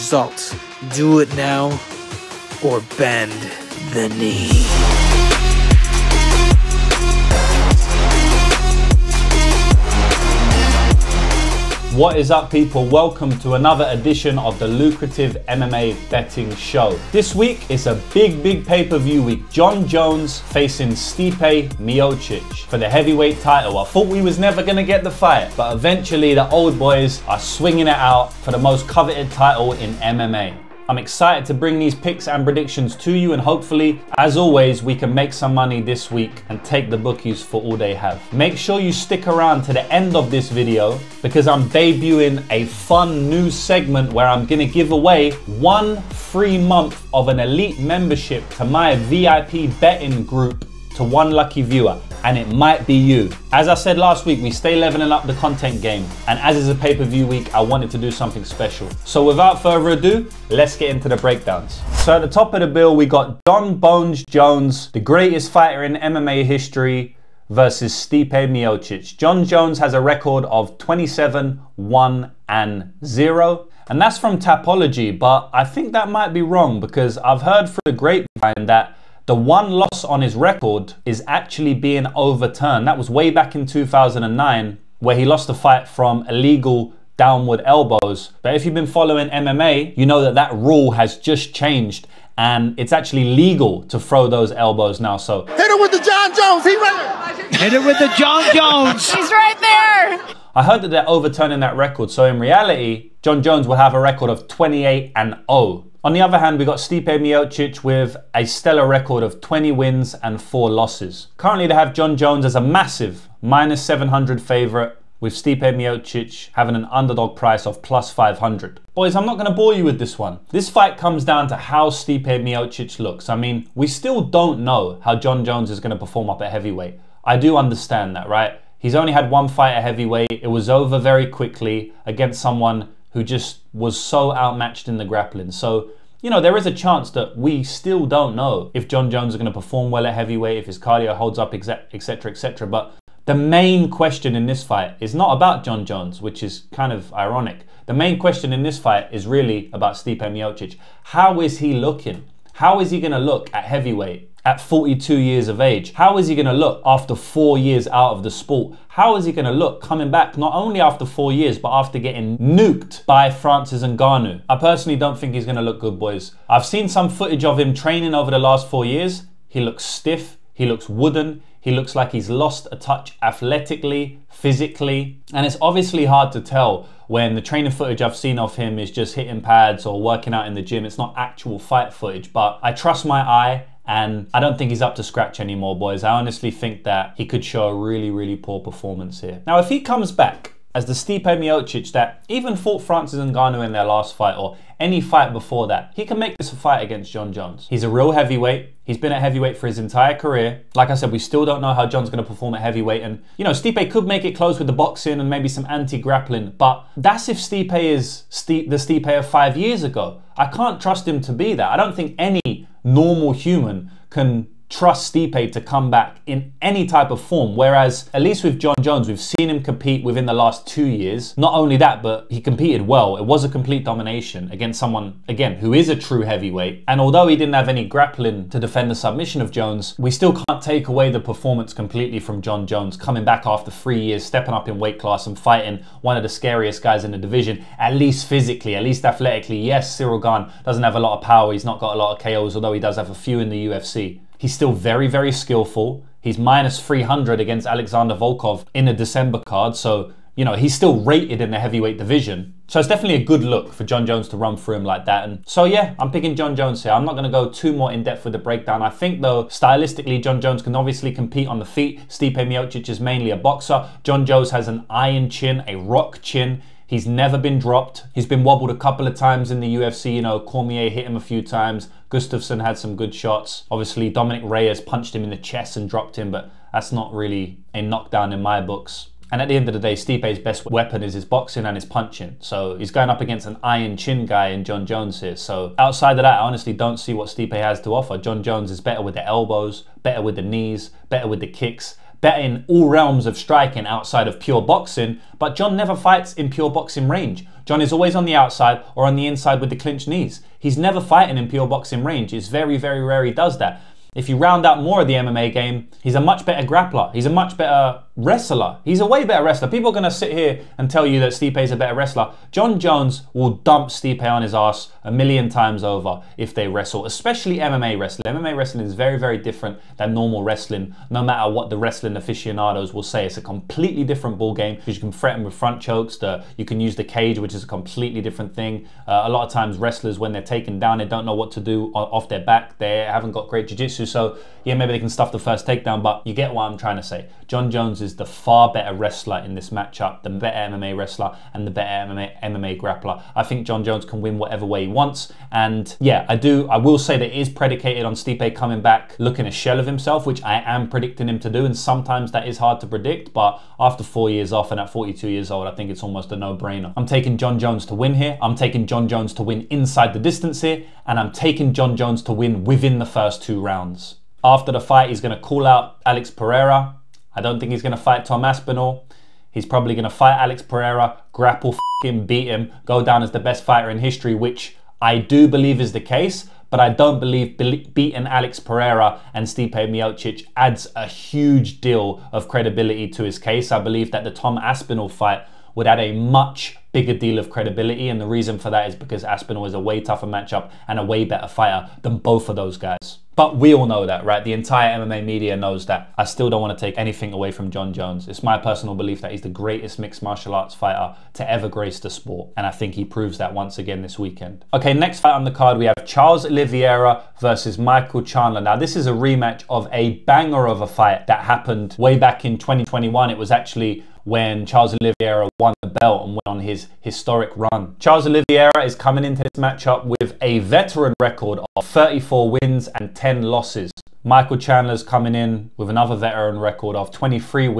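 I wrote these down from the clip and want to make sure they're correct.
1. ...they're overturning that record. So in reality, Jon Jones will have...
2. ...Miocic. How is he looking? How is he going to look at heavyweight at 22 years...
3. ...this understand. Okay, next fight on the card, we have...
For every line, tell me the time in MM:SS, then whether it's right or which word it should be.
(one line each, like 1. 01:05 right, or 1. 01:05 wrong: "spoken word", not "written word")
1. 01:40 right
2. 02:30 wrong: "42", not "22"
3. 06:44 wrong: "weekend", not "understand".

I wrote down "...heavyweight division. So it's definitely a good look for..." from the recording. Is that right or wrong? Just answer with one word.
right.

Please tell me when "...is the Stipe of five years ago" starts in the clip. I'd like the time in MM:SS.
03:27.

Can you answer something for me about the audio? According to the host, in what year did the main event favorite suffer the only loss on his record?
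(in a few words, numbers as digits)
2009.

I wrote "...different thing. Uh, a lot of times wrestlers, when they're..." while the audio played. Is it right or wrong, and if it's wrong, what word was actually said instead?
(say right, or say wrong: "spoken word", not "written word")
right.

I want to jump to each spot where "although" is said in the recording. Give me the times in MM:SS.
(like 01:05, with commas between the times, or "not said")
03:47, 04:02.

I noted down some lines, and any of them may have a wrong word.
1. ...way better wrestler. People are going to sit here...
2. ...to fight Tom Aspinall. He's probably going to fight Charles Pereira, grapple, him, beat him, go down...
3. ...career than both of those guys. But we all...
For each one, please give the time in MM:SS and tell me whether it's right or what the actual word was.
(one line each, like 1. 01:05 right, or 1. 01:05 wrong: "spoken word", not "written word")
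1. 05:09 right
2. 06:07 wrong: "Alex", not "Charles"
3. 06:31 wrong: "fighter", not "career".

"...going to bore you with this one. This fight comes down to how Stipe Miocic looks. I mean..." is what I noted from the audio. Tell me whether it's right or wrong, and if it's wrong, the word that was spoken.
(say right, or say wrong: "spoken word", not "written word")
right.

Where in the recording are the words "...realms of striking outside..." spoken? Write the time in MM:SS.
04:52.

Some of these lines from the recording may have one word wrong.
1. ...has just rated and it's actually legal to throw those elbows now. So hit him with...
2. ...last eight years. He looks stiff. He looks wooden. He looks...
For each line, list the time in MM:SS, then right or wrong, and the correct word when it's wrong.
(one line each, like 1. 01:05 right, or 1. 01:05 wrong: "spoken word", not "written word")
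1. 01:30 wrong: "changed", not "rated"
2. 02:48 wrong: "four", not "eight".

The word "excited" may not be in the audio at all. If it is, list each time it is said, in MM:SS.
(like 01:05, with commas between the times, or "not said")
00:30.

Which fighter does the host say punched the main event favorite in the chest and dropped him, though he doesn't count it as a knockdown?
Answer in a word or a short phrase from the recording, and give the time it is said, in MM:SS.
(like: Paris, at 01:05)
Dominick Reyes, at 04:34.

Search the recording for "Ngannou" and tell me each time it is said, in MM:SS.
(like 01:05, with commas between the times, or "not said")
02:43, 03:13.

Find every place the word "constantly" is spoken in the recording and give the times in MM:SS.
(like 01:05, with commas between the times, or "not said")
not said.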